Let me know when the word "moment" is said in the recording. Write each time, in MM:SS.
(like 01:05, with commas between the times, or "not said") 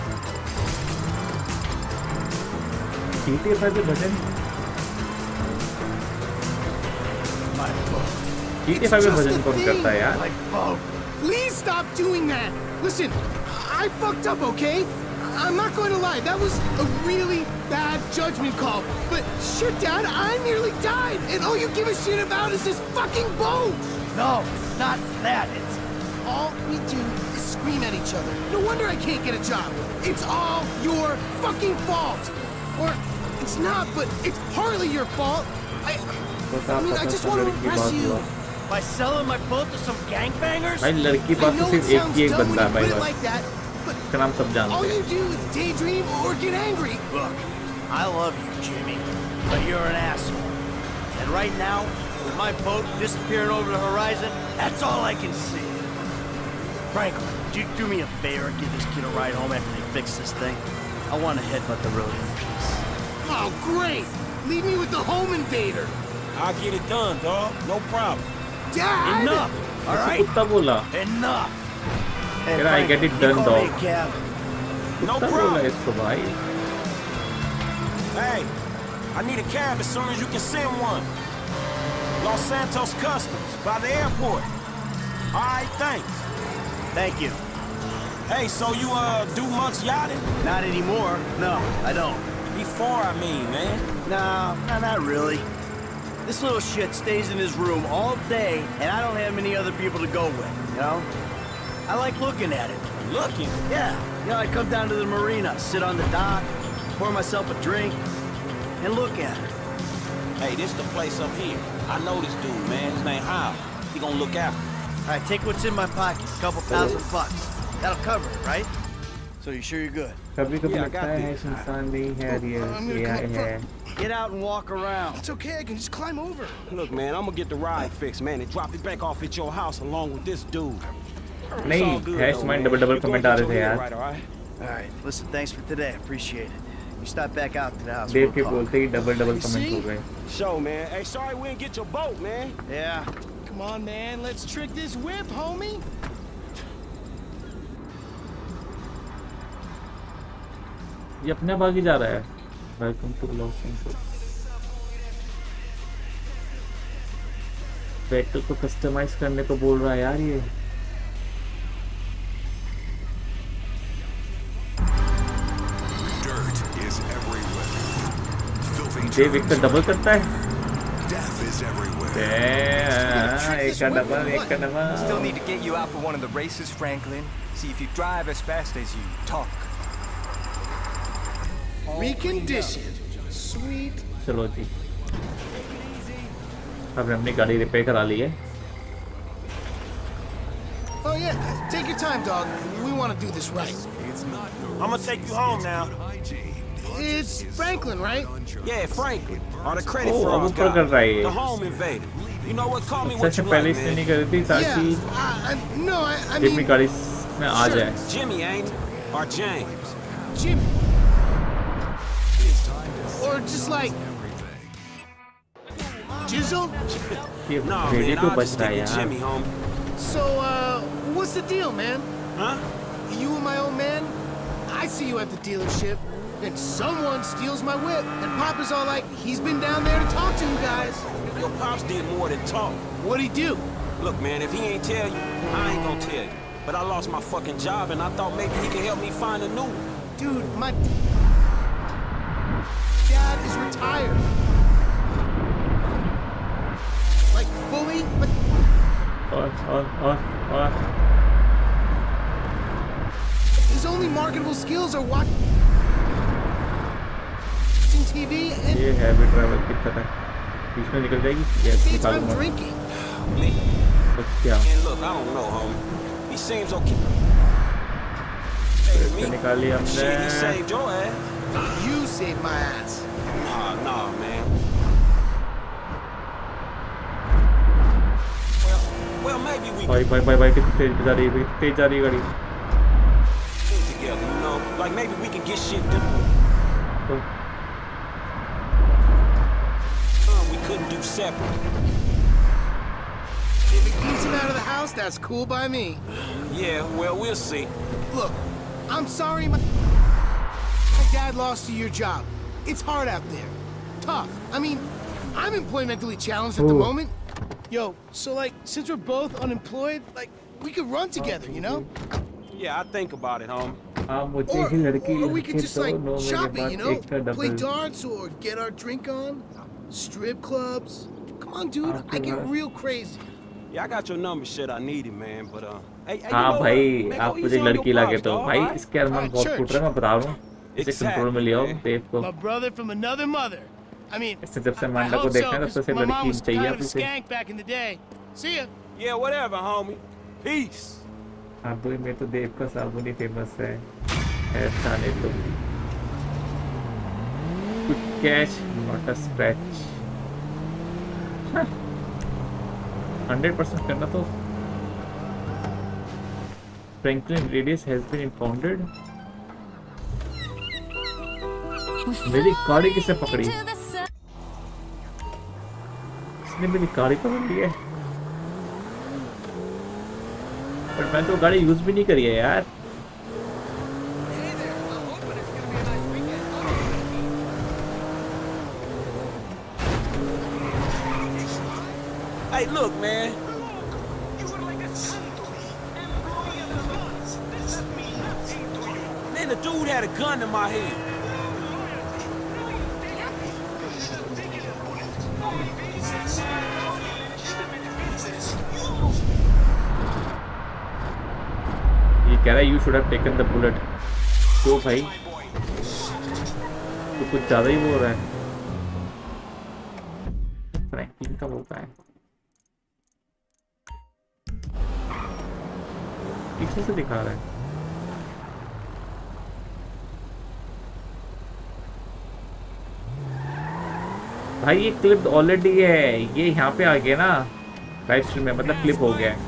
05:06.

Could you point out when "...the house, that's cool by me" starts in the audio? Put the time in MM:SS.
04:54.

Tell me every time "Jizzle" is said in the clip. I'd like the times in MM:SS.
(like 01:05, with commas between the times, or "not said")
03:36.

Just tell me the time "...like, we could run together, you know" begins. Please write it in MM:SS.
05:10.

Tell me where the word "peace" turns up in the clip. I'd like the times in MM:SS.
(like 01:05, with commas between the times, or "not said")
01:02, 05:40.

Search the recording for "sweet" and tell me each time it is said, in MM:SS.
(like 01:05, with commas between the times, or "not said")
03:03.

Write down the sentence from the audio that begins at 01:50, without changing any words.
Hey, this the place up here.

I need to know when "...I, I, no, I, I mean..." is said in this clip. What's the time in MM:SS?
03:25.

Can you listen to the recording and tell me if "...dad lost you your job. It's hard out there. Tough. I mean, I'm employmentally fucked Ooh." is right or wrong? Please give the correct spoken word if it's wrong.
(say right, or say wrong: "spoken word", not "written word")
wrong: "challenged", not "fucked".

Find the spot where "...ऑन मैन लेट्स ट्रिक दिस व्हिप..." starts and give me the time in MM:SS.
02:23.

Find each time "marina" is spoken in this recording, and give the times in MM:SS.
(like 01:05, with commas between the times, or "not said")
01:45.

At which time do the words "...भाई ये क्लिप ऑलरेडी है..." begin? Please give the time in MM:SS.
07:04.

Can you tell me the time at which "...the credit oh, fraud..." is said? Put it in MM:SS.
03:19.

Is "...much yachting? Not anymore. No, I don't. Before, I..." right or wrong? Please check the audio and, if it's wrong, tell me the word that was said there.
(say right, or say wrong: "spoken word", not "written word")
right.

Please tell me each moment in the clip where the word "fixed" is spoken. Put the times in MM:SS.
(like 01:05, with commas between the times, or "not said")
02:07.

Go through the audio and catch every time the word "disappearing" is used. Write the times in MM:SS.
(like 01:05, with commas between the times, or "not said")
00:52.